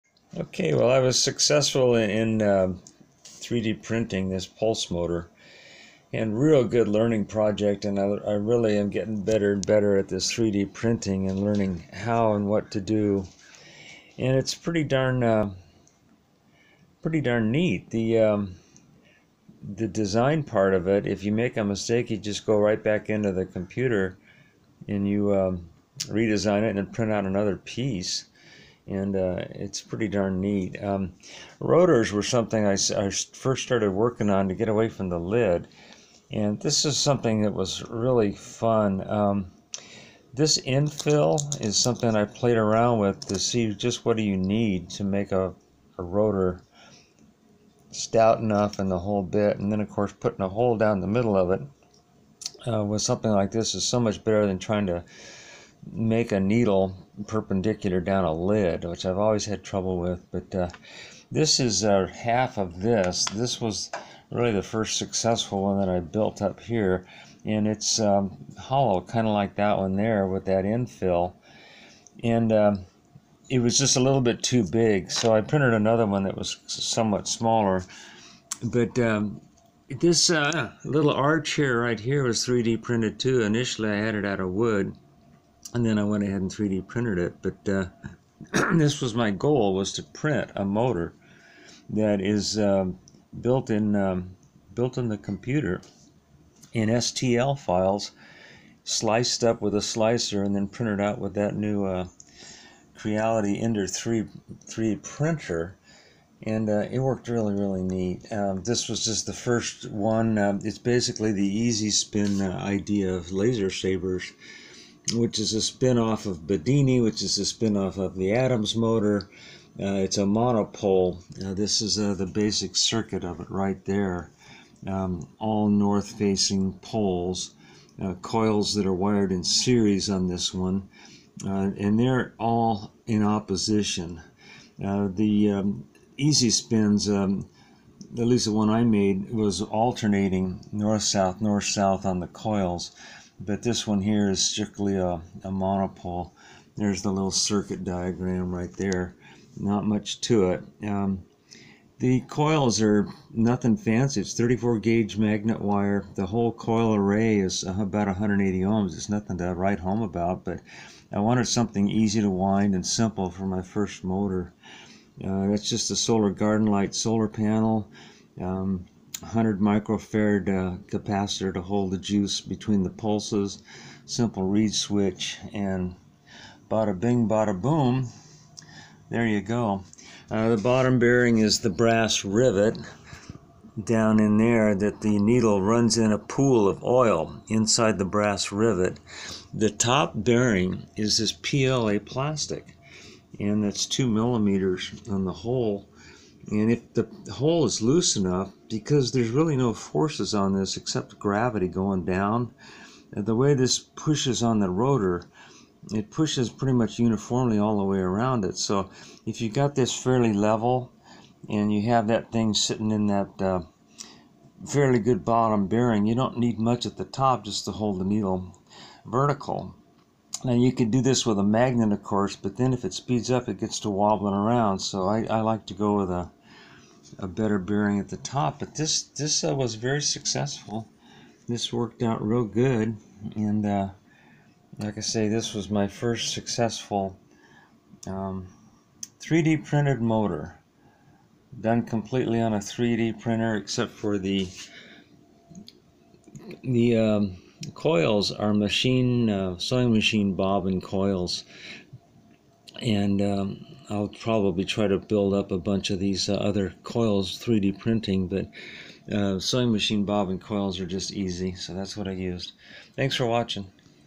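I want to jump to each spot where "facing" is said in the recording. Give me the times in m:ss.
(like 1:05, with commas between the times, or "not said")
2:05.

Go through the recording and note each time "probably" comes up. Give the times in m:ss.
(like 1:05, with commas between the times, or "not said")
4:14.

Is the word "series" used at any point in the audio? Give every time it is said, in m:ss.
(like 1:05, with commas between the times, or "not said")
2:09.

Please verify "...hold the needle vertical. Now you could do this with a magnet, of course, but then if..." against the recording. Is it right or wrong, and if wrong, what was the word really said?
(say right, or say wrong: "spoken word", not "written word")
right.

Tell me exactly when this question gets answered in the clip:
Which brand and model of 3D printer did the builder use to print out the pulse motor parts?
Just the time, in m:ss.
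1:42.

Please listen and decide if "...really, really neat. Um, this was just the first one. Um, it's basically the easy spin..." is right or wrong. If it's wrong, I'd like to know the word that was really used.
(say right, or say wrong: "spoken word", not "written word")
right.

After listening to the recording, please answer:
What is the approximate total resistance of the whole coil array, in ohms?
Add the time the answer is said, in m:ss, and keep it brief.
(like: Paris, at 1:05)
180 ohms, at 2:38.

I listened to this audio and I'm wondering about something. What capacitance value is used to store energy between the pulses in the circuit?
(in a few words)
100 microfarad.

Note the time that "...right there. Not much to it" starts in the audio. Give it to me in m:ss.
2:28.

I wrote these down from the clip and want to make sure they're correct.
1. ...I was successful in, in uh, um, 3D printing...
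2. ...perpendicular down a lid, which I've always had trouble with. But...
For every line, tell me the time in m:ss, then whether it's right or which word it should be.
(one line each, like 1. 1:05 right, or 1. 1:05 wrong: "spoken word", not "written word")
1. 0:00 right
2. 0:57 right.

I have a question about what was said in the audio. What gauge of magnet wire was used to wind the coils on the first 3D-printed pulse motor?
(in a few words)
34 gauge.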